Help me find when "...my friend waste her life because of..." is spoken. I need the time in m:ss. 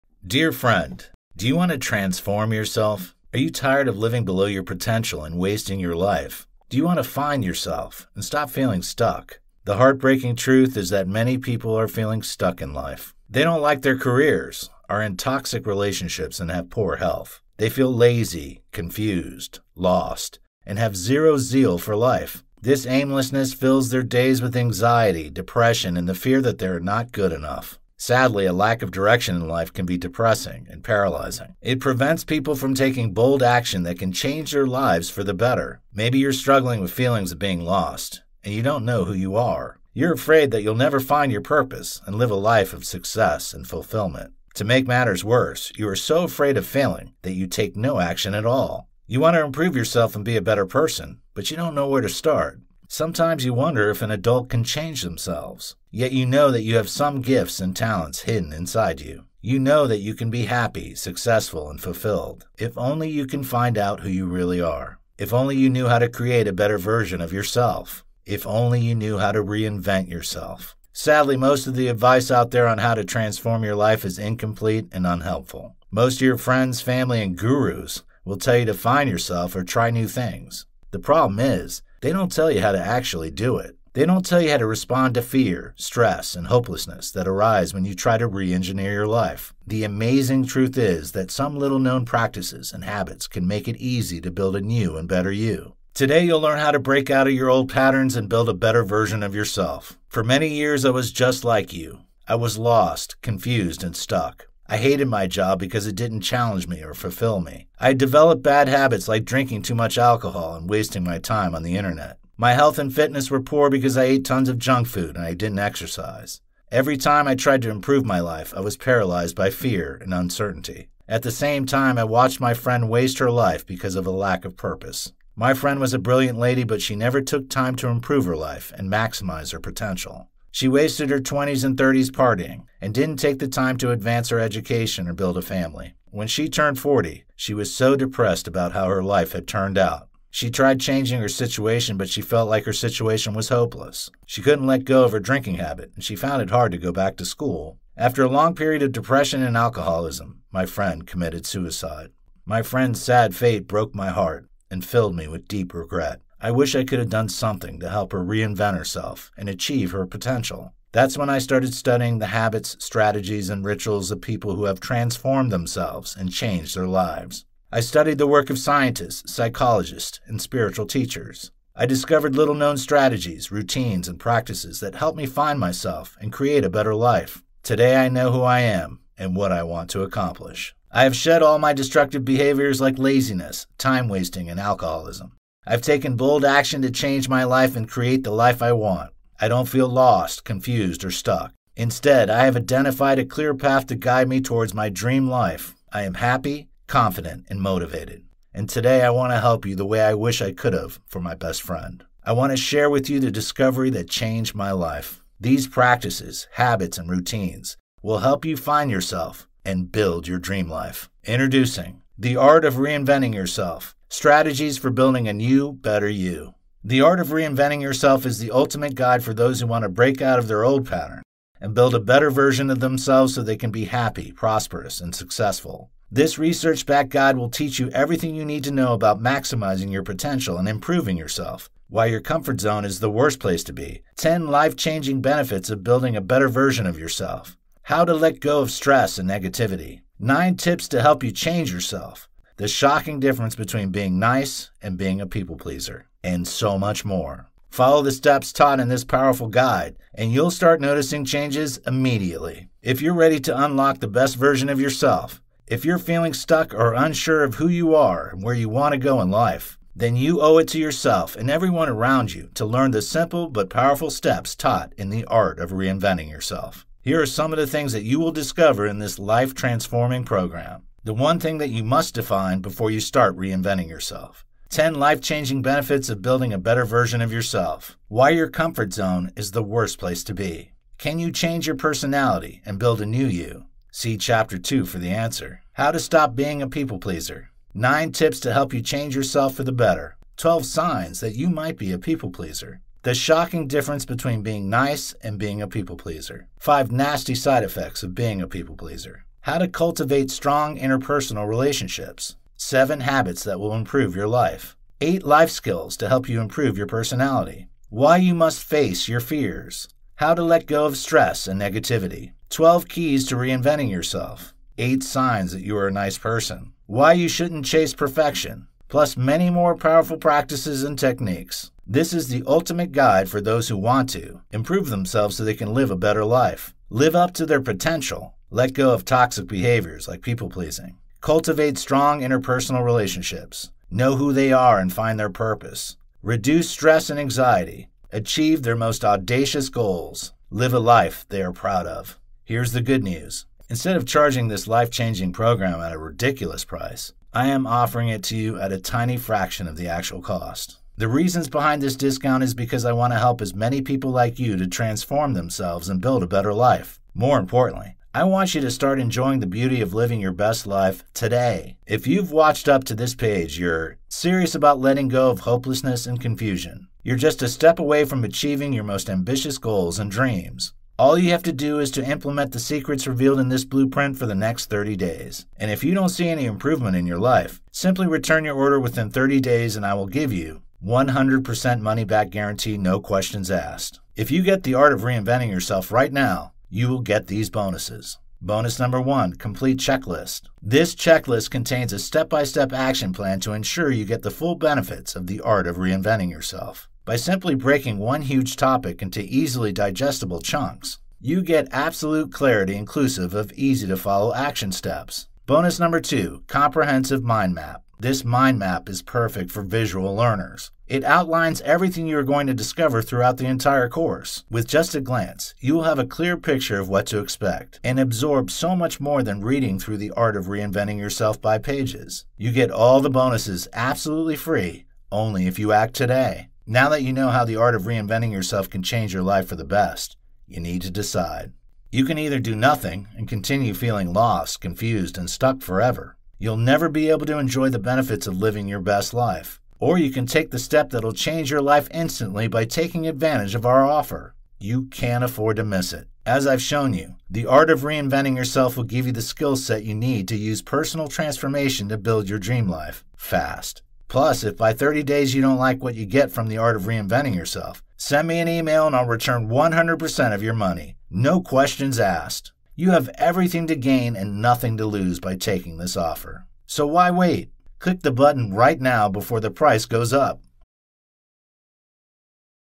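2:02.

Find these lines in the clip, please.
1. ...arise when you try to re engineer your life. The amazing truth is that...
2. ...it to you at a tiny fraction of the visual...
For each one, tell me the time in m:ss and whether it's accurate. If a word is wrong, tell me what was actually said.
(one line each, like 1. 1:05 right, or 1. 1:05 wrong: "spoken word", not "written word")
1. 1:27 right
2. 5:48 wrong: "actual", not "visual".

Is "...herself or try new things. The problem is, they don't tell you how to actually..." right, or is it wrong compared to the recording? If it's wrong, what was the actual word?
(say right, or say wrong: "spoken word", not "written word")
wrong: "yourself", not "herself".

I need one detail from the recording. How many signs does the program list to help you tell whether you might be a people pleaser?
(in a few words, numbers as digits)
12.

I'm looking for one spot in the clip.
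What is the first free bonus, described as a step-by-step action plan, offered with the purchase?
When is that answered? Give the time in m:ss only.
6:29.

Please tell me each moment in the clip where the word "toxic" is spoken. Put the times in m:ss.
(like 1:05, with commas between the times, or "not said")
0:15, 5:29.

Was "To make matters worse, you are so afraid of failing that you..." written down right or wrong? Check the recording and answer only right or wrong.
right.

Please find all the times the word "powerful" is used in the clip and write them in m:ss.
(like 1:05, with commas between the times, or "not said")
4:09, 4:23, 5:19.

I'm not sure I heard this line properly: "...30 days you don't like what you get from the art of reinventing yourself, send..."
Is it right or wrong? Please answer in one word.
right.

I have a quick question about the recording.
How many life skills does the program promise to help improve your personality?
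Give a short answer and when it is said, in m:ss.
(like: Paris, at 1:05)
8, at 5:05.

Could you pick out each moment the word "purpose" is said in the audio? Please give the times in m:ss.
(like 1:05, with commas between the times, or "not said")
0:41, 2:04, 5:35.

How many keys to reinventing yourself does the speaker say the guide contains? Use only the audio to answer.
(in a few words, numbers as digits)
12.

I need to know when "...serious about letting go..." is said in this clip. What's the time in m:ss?
6:04.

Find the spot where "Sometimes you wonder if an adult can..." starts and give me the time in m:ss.
0:52.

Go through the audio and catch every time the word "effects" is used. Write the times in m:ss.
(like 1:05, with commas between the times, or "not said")
4:57.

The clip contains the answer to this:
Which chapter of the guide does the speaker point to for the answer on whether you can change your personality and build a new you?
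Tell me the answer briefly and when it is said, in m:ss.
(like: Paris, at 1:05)
Chapter 2, at 4:44.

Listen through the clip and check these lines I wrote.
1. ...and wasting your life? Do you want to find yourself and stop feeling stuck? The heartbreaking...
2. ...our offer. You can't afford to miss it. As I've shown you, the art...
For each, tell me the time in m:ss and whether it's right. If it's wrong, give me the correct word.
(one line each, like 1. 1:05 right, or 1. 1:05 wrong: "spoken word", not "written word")
1. 0:05 right
2. 7:23 right.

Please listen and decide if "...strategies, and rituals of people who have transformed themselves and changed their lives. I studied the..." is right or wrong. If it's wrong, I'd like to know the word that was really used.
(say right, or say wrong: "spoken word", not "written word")
right.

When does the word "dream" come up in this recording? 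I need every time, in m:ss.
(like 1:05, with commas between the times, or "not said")
3:14, 3:30, 6:10, 7:32.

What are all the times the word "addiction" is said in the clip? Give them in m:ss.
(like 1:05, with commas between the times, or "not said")
not said.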